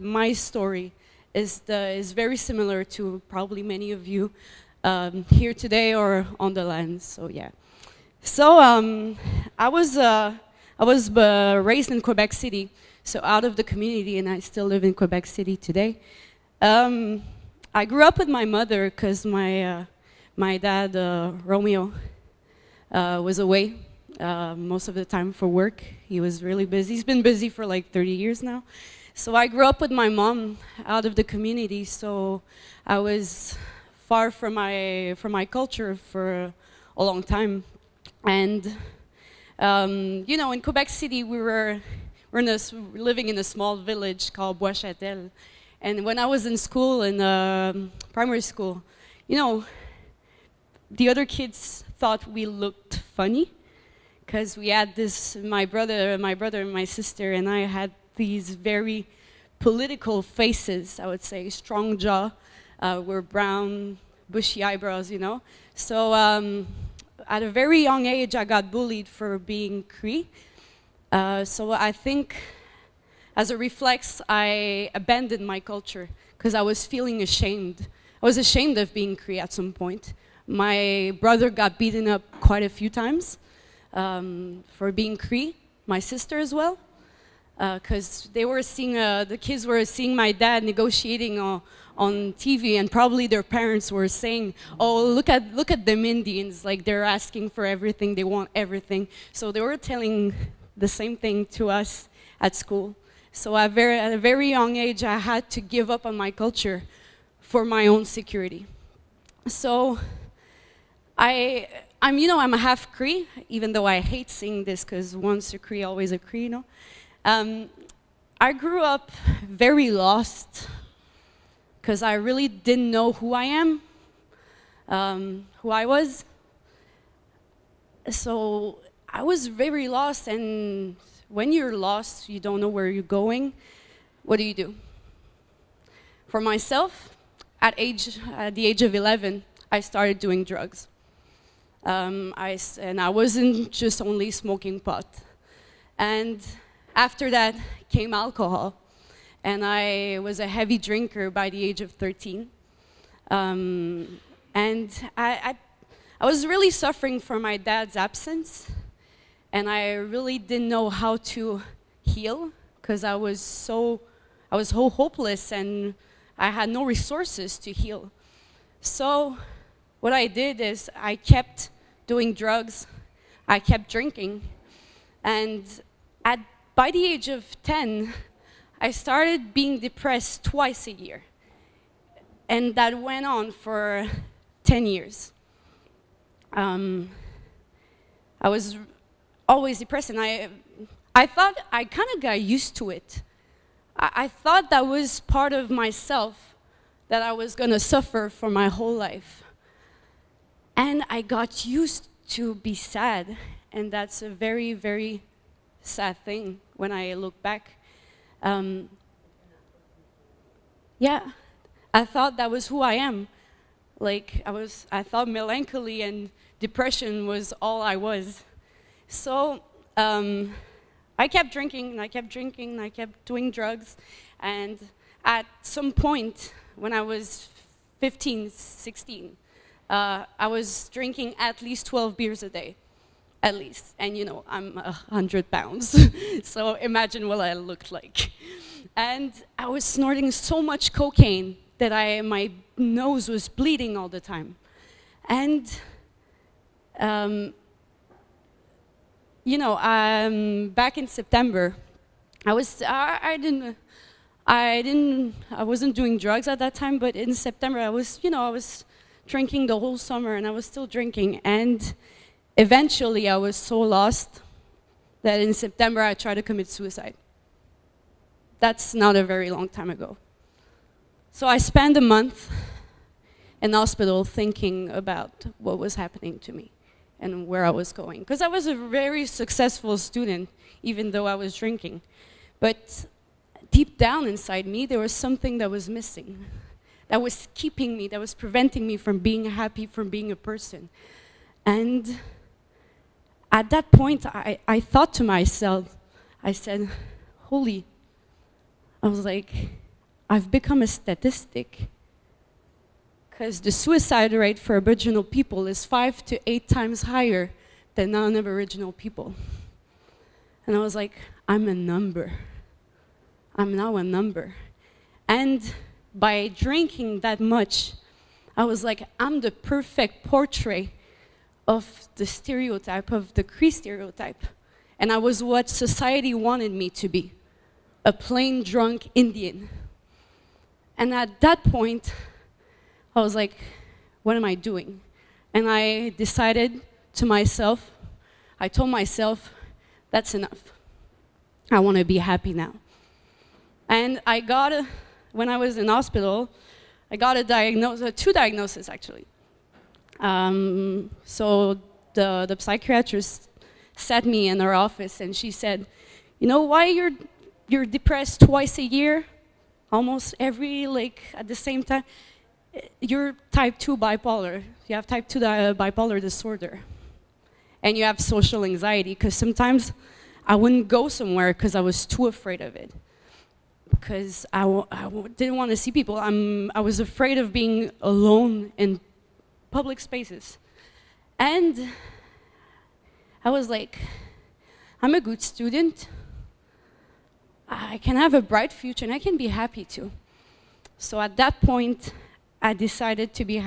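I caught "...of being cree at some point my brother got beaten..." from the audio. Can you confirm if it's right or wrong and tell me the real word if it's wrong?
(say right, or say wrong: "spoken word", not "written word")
right.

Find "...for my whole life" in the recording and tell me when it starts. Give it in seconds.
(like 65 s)
198 s.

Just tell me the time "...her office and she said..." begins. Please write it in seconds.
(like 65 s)
354 s.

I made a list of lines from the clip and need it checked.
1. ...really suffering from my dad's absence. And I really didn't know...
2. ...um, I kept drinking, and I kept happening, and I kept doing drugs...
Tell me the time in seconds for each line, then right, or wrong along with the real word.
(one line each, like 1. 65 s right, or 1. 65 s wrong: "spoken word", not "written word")
1. 156 s right
2. 219 s wrong: "drinking", not "happening".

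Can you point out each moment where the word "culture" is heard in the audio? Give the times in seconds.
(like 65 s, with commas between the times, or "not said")
35 s, 75 s, 106 s.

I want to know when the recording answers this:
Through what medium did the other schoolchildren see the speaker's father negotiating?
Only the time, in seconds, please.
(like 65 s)
92 s.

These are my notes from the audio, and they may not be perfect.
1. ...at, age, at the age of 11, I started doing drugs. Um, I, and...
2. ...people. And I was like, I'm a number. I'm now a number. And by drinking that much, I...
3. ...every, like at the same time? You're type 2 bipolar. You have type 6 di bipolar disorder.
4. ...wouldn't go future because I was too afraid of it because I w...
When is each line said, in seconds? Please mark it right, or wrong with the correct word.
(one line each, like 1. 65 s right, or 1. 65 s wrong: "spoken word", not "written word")
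1. 137 s right
2. 308 s right
3. 360 s wrong: "2", not "6"
4. 370 s wrong: "somewhere", not "future".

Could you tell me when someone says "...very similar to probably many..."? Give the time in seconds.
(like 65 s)
2 s.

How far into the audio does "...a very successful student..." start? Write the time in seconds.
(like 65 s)
278 s.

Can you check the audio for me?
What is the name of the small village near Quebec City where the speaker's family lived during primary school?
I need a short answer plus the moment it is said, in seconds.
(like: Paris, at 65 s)
Boischatel, at 44 s.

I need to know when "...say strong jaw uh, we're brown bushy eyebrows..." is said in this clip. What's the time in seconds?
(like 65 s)
61 s.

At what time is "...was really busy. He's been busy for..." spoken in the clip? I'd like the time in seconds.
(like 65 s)
26 s.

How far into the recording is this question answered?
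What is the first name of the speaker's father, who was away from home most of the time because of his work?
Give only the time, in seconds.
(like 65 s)
21 s.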